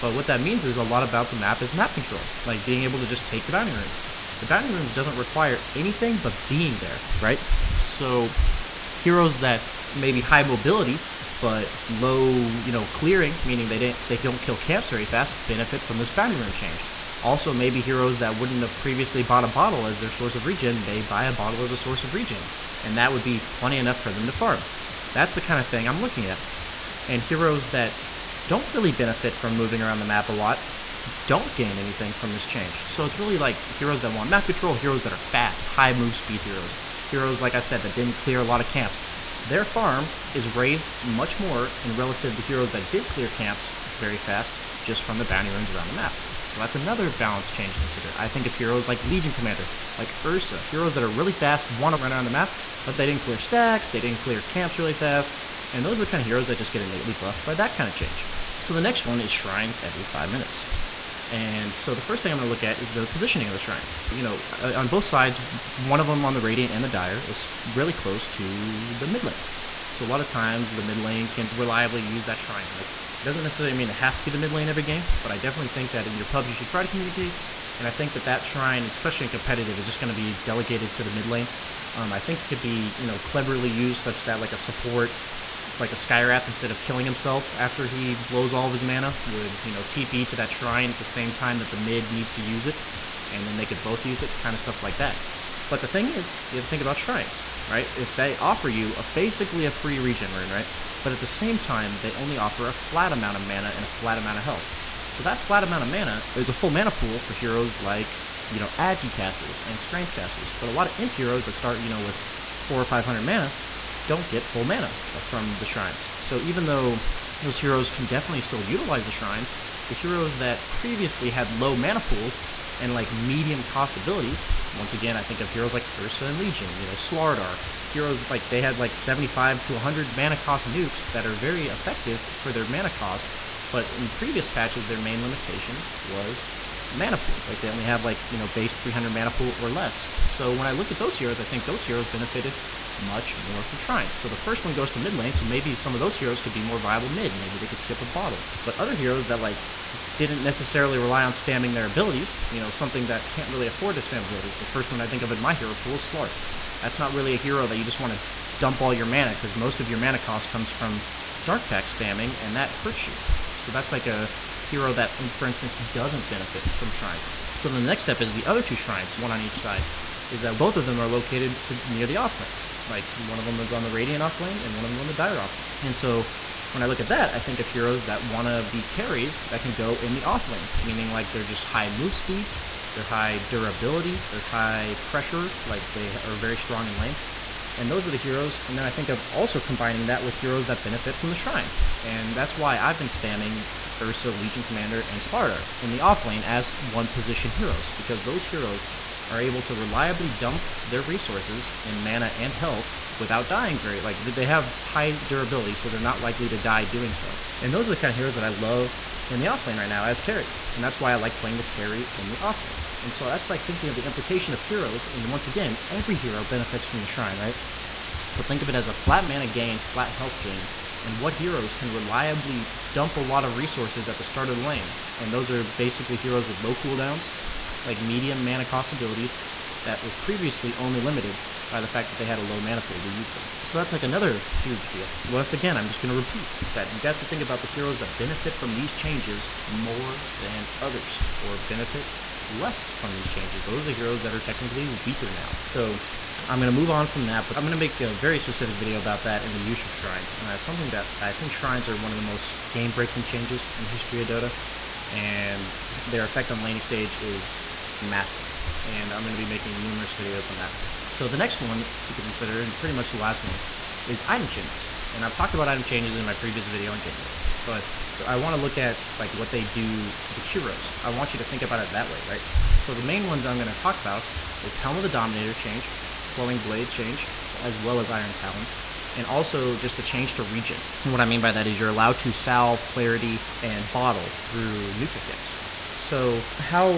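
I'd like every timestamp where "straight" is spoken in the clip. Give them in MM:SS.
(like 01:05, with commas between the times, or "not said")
not said.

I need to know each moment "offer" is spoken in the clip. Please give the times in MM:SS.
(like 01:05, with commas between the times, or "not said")
01:38, 01:42.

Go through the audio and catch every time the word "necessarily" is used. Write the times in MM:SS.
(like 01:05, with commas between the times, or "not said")
01:13, 02:30.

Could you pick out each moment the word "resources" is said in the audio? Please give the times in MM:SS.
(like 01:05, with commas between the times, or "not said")
03:21, 03:43.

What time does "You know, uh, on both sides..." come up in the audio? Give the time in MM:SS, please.
01:04.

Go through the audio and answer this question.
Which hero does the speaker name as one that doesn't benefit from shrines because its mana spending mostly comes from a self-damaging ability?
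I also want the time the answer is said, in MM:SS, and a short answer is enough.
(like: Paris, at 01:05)
Slark, at 02:36.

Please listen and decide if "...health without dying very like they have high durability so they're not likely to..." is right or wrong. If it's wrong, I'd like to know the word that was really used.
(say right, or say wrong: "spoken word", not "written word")
right.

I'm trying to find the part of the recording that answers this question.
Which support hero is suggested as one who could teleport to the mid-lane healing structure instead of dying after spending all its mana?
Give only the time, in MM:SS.
01:25.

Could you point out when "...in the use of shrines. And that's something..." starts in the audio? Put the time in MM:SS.
04:09.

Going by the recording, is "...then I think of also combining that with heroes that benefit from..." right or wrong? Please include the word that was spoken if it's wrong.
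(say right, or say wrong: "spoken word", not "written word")
right.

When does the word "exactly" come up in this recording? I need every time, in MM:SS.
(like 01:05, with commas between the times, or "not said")
not said.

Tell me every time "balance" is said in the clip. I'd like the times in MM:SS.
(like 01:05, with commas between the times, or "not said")
00:47.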